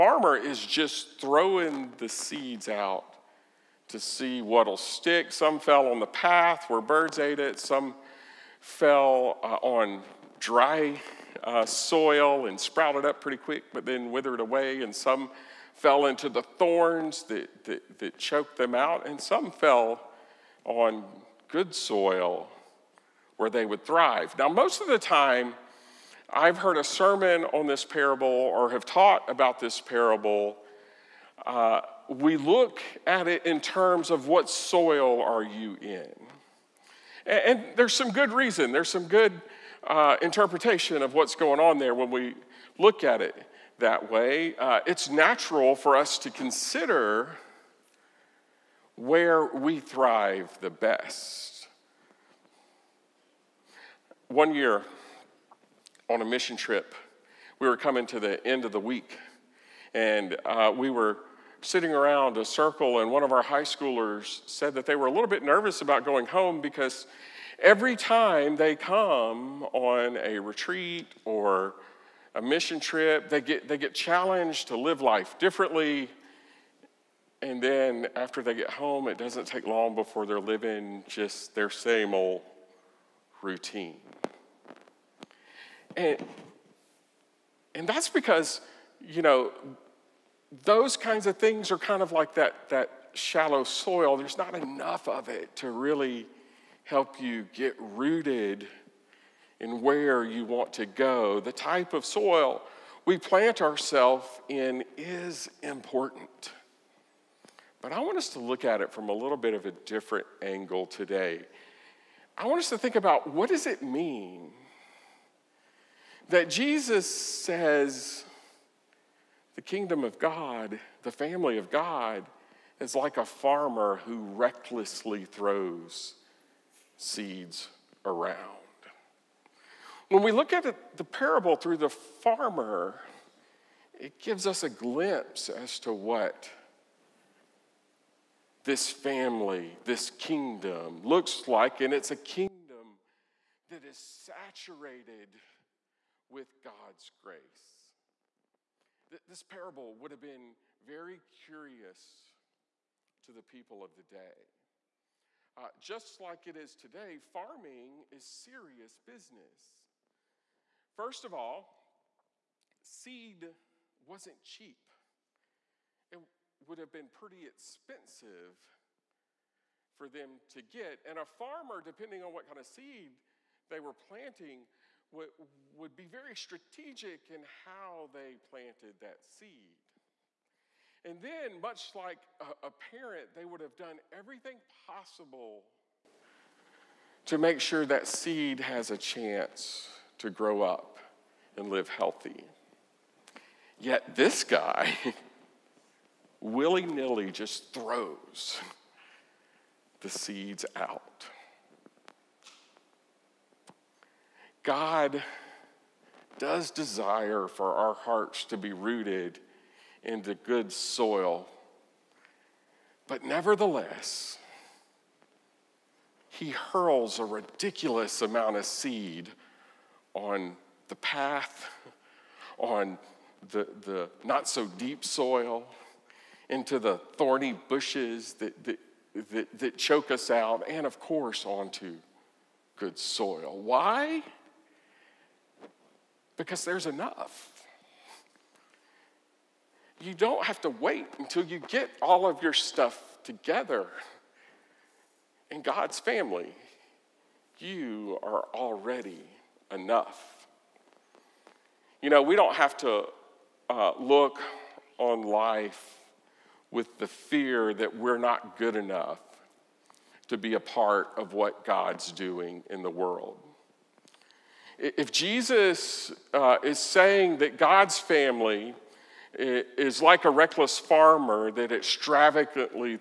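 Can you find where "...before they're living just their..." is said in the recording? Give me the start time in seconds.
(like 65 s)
79 s.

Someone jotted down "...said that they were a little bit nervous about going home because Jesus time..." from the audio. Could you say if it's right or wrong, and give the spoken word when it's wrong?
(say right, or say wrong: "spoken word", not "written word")
wrong: "Every", not "Jesus".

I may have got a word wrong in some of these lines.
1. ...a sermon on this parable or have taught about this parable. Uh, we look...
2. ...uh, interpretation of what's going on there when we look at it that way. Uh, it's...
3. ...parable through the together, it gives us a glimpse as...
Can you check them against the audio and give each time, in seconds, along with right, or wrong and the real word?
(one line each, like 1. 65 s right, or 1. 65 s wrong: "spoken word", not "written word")
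1. 26 s right
2. 39 s right
3. 131 s wrong: "farmer", not "together".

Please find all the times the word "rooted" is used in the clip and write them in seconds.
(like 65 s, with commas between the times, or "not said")
97 s, 208 s.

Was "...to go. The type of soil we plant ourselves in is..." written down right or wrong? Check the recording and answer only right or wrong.
right.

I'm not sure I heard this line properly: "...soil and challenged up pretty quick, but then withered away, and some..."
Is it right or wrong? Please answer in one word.
wrong.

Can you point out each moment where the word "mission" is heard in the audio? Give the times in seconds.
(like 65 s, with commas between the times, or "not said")
56 s, 72 s.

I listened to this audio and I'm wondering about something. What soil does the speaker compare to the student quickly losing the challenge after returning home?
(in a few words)
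shallow soil.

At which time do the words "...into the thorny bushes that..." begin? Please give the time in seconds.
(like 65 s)
226 s.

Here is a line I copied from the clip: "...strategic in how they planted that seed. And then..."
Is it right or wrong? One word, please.
right.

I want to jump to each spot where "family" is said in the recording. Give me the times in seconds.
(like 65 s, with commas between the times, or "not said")
121 s, 138 s, 245 s, 267 s.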